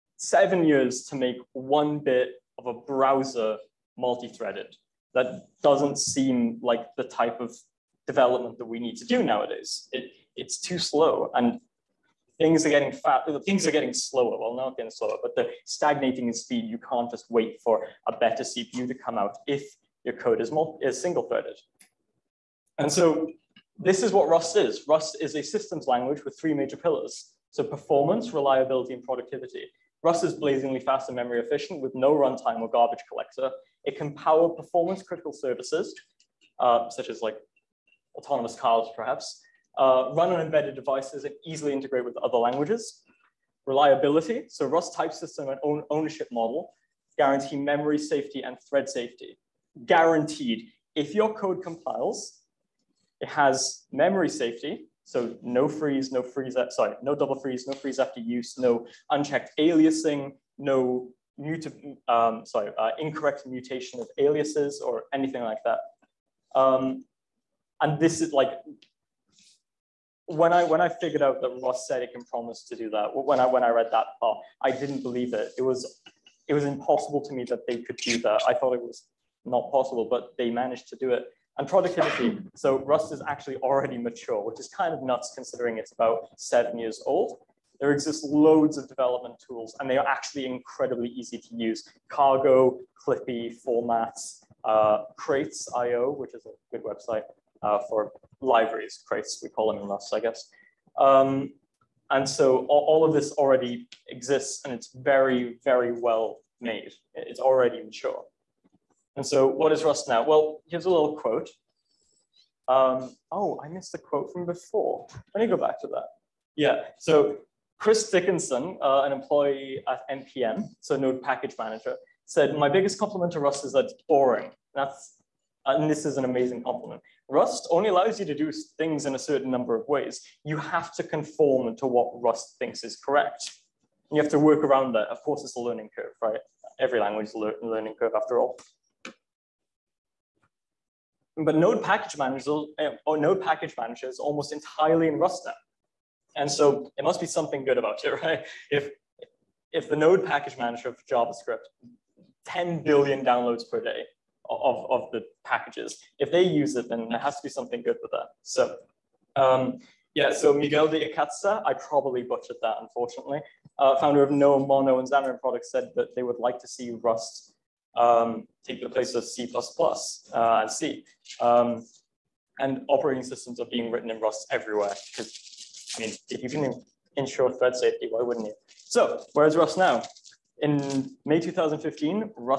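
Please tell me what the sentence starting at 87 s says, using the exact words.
There exist loads of development tools and they are actually incredibly easy to use.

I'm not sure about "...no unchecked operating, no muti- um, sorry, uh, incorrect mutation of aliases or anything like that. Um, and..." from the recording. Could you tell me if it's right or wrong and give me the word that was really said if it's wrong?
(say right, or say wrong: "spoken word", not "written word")
wrong: "aliasing", not "operating".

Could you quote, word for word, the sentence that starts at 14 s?
Well, not getting slower, but they're stagnating in speed.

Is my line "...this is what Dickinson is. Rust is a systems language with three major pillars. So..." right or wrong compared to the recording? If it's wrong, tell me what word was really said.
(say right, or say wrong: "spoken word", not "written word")
wrong: "Rust", not "Dickinson".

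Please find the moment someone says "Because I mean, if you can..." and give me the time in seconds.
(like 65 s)
175 s.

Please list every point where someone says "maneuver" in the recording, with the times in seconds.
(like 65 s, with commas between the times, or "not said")
not said.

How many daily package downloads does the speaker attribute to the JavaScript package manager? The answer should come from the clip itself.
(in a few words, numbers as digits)
10 billion.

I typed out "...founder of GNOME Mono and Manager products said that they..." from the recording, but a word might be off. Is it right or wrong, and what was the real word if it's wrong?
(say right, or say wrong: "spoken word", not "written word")
wrong: "Xamarin", not "Manager".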